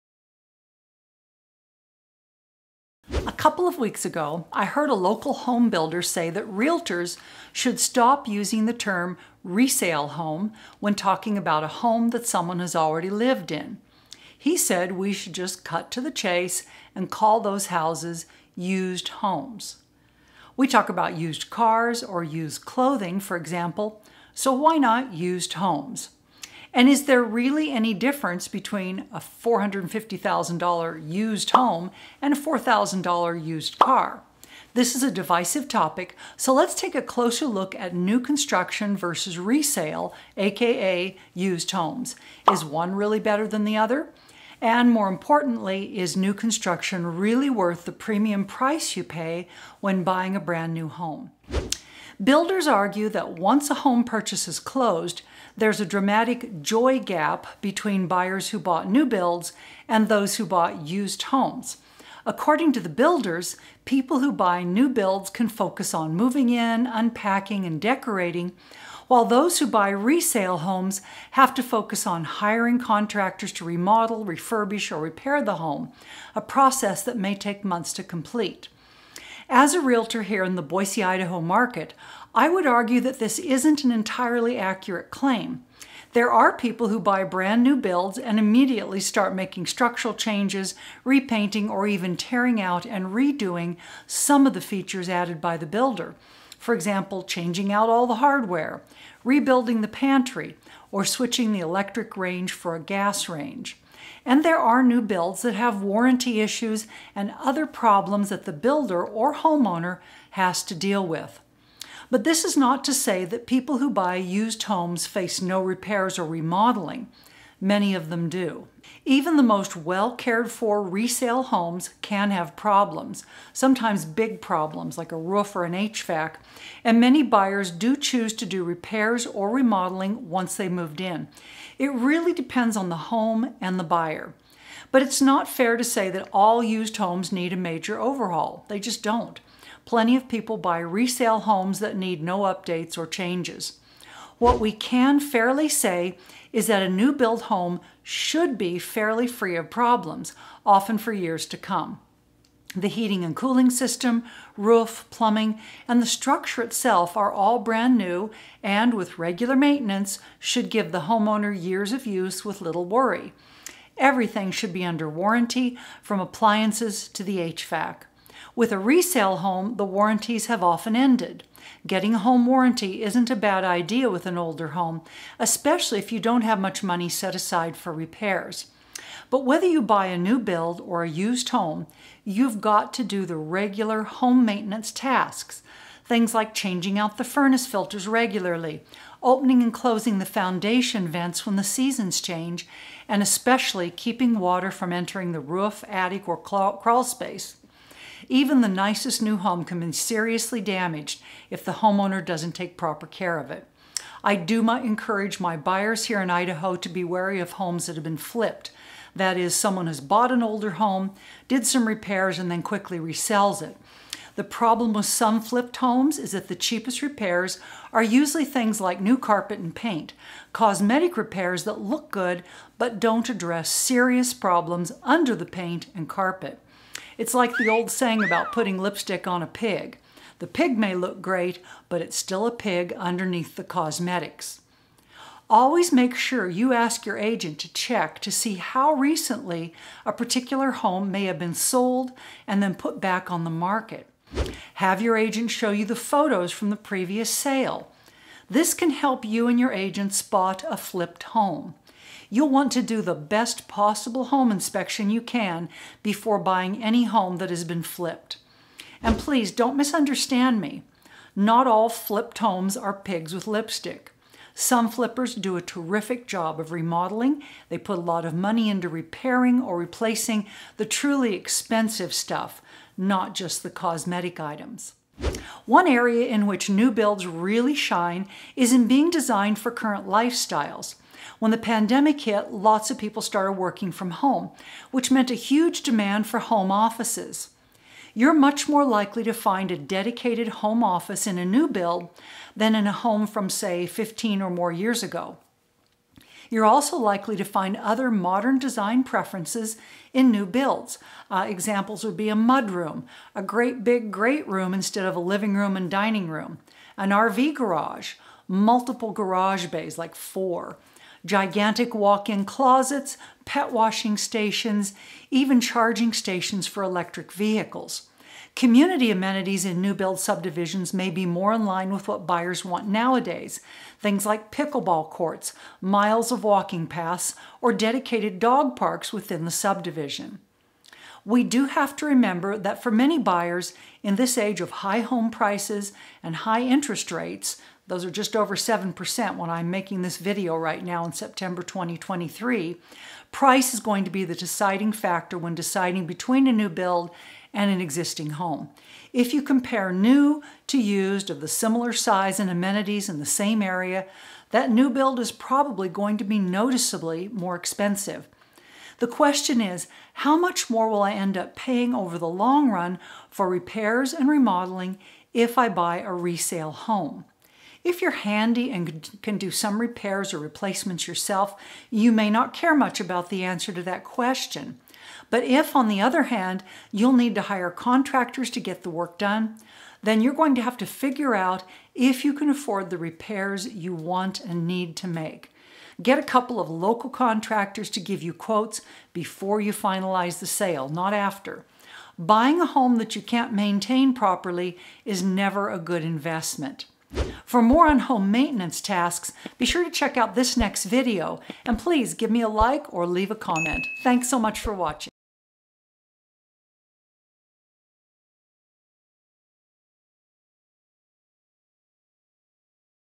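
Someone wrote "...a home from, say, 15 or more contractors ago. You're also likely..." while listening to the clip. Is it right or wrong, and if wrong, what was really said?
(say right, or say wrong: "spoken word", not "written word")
wrong: "years", not "contractors".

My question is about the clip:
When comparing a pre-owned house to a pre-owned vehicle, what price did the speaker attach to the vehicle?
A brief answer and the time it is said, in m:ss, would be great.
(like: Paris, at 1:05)
$4,000, at 0:32.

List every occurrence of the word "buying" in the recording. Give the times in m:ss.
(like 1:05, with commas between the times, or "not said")
0:50, 4:16, 6:32.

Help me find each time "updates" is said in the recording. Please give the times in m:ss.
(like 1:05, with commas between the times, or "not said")
2:22.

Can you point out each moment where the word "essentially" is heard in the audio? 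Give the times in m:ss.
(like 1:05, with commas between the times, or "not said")
not said.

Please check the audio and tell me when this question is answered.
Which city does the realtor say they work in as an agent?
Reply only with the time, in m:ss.
1:20.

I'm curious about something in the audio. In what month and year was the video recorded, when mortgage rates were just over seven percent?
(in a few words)
September 2023.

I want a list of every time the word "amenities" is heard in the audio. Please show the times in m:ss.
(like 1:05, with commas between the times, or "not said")
5:19, 5:52.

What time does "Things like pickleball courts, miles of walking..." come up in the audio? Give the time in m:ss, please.
5:23.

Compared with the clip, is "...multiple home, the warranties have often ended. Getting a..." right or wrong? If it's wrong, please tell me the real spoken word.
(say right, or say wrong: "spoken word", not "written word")
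wrong: "resale", not "multiple".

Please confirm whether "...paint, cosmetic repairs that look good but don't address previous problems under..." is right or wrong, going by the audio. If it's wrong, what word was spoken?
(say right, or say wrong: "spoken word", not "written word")
wrong: "serious", not "previous".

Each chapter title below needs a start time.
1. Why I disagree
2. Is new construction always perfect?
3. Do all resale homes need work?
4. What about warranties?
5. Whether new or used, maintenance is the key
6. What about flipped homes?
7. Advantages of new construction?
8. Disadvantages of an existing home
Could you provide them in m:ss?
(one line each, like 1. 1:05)
1. 1:27
2. 1:56
3. 2:20
4. 2:53
5. 3:19
6. 4:00
7. 4:43
8. 6:08.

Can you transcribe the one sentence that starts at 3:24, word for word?
I do my, encourage my buyers here in Idaho to be wary of homes that have been flipped.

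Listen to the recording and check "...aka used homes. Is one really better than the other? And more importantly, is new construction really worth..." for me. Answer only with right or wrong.
right.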